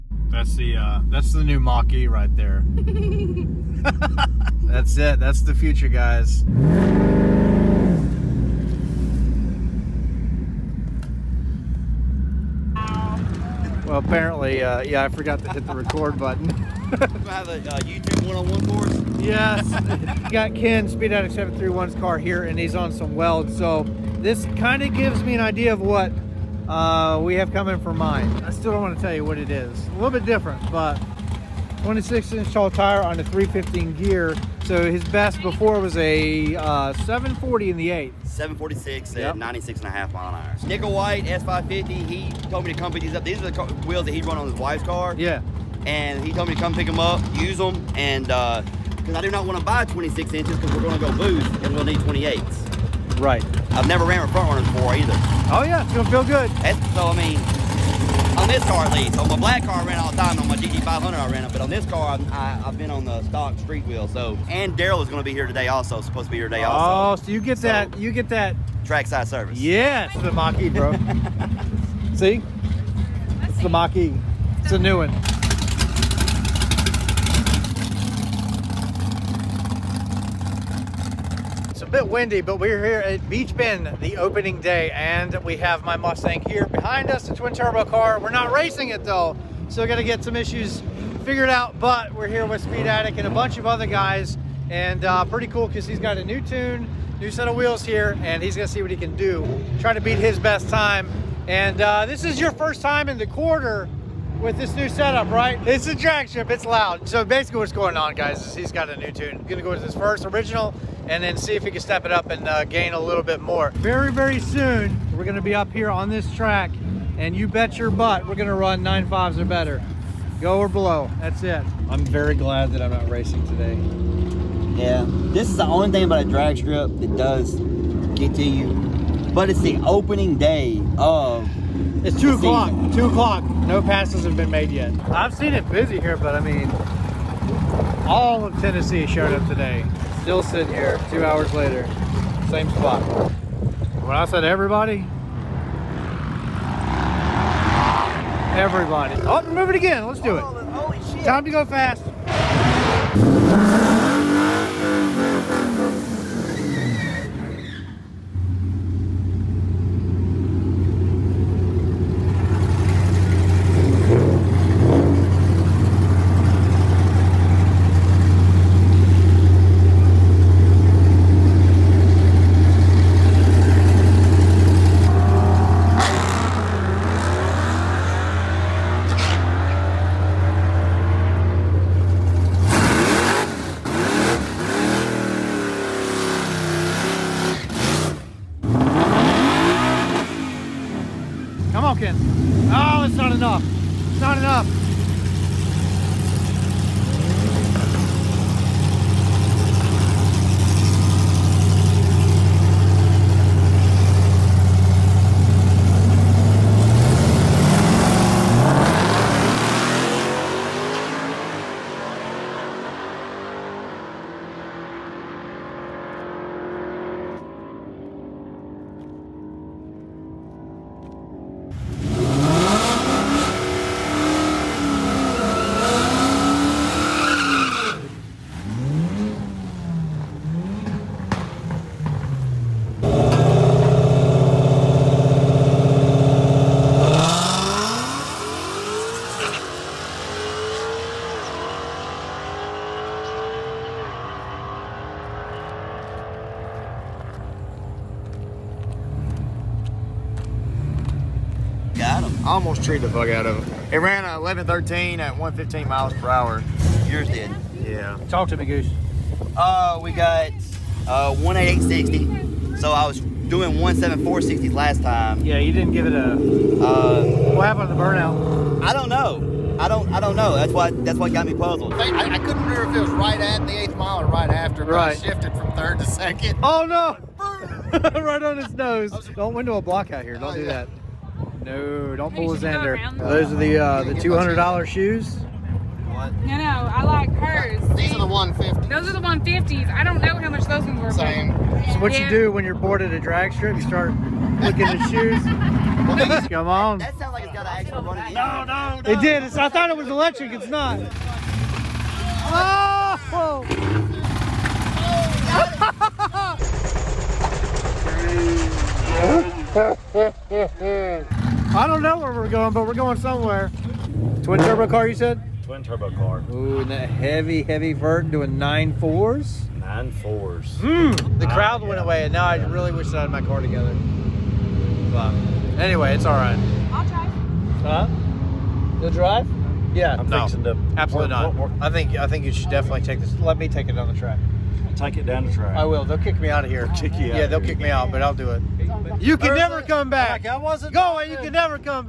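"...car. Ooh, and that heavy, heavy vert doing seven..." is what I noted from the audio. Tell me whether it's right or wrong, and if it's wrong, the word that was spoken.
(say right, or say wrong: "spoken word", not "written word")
wrong: "nine", not "seven".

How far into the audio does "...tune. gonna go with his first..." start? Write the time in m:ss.
1:49.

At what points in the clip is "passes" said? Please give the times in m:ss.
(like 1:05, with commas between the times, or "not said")
2:13.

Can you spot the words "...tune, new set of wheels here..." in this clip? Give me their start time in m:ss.
1:36.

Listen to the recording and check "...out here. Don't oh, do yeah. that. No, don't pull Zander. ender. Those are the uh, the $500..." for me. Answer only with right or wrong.
wrong.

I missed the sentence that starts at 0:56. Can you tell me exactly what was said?
That's, so I mean, on this car at least.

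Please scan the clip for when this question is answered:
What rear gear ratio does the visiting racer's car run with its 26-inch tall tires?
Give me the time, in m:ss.
0:33.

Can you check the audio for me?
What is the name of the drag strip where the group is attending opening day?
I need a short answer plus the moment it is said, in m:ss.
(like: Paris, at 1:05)
Beech Bend, at 1:23.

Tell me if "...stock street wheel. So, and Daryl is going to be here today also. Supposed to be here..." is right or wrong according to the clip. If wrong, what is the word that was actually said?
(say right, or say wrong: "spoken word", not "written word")
right.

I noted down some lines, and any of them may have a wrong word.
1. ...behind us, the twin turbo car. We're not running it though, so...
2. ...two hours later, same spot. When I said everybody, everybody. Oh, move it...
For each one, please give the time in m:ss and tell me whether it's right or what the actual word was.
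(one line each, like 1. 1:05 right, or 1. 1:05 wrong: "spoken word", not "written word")
1. 1:26 wrong: "racing", not "running"
2. 2:21 right.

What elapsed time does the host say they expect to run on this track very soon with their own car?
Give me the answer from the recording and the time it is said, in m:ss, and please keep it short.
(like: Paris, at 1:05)
9.5s or better, at 1:58.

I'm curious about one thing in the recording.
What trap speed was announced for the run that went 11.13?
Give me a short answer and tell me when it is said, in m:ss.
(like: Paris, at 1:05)
115 mph, at 4:15.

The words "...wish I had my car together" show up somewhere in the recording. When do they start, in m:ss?
5:22.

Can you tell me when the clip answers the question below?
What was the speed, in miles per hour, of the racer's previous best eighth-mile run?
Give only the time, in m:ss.
0:39.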